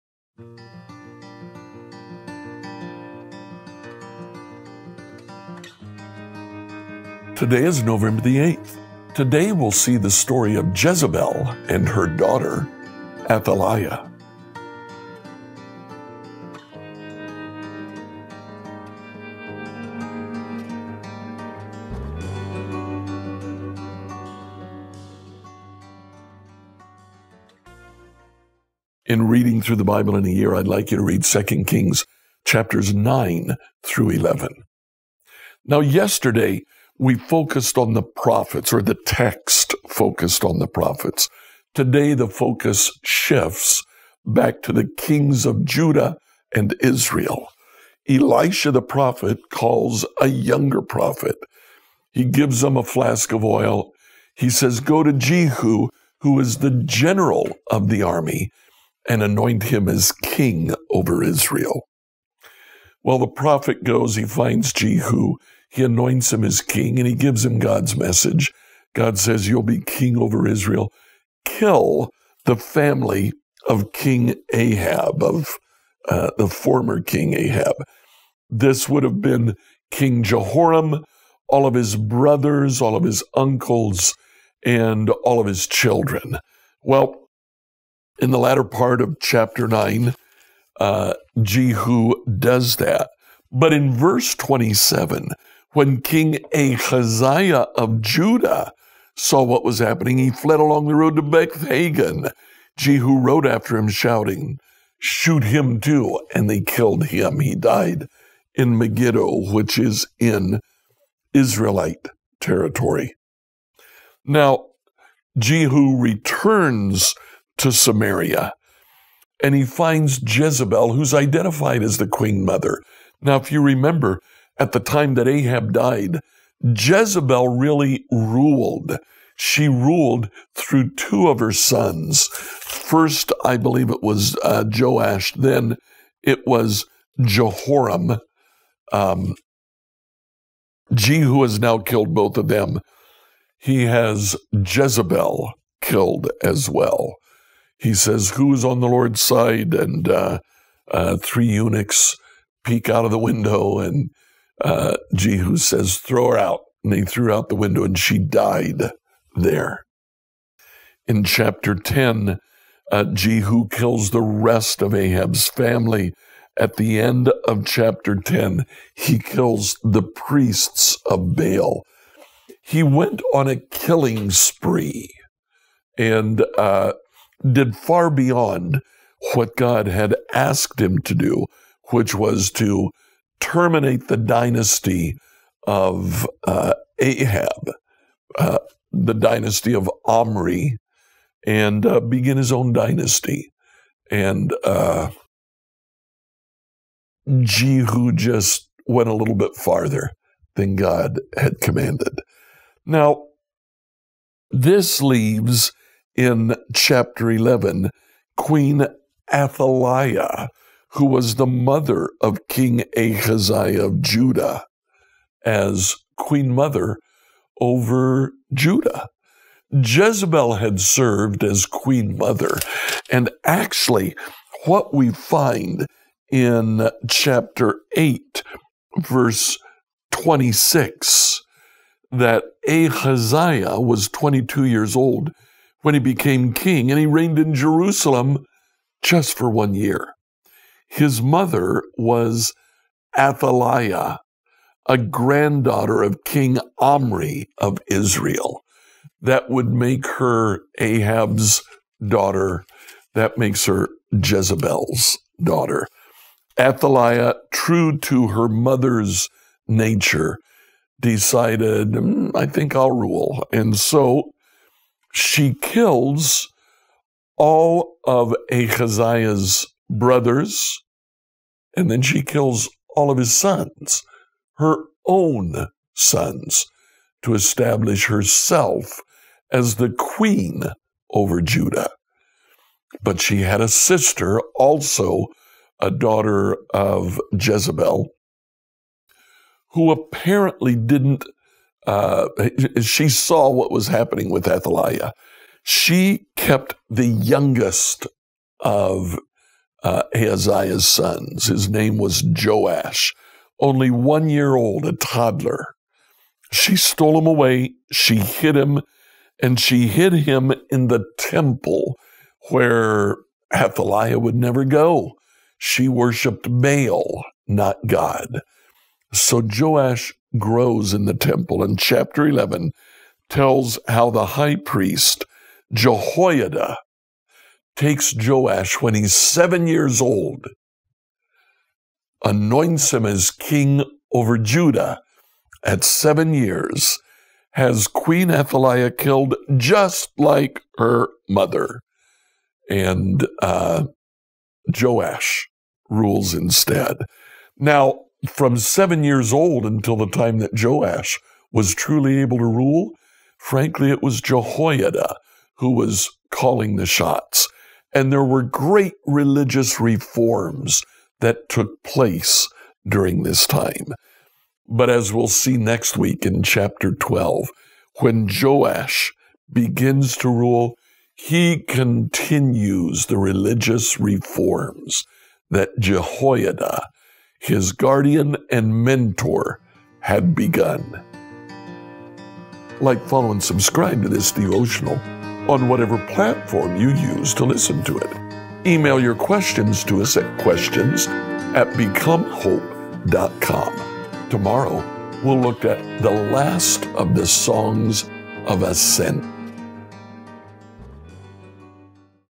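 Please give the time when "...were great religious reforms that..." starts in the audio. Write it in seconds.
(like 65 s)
358 s.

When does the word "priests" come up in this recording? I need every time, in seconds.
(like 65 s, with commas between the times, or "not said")
170 s, 324 s.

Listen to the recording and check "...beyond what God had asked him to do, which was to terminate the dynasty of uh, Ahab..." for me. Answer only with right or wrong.
right.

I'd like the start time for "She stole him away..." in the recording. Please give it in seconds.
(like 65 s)
306 s.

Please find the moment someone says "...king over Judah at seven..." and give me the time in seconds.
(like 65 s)
333 s.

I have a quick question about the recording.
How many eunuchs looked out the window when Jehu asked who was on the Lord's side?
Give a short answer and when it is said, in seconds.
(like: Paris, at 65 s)
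3, at 151 s.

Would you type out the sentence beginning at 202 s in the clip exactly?
Now, this leaves in chapter 11, Queen Athaliah, who was the mother of King Ahaziah of Judah, as queen mother over Judah.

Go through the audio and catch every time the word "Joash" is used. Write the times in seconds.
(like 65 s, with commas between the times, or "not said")
134 s, 302 s, 319 s, 328 s, 344 s, 350 s, 368 s.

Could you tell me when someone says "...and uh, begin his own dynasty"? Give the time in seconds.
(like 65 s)
191 s.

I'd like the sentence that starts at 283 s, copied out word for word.
But she had a sister, also a daughter of Jezebel, who apparently didn't uh, she saw what was happening with Athaliah.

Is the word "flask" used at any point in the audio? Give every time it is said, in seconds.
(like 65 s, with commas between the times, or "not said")
52 s.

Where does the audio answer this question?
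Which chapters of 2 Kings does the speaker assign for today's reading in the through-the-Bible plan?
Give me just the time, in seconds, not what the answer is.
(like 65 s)
32 s.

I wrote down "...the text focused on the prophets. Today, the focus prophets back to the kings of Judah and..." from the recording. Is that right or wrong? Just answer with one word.
wrong.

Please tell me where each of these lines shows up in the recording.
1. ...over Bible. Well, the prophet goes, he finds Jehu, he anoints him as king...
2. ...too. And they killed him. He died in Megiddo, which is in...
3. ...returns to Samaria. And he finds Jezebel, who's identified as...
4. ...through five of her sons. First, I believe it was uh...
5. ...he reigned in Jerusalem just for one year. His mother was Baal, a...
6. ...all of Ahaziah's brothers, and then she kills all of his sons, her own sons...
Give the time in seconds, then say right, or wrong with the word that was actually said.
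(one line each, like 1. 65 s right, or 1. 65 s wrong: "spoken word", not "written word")
1. 60 s wrong: "Israel", not "Bible"
2. 105 s right
3. 115 s right
4. 130 s wrong: "two", not "five"
5. 236 s wrong: "Athaliah", not "Baal"
6. 267 s right.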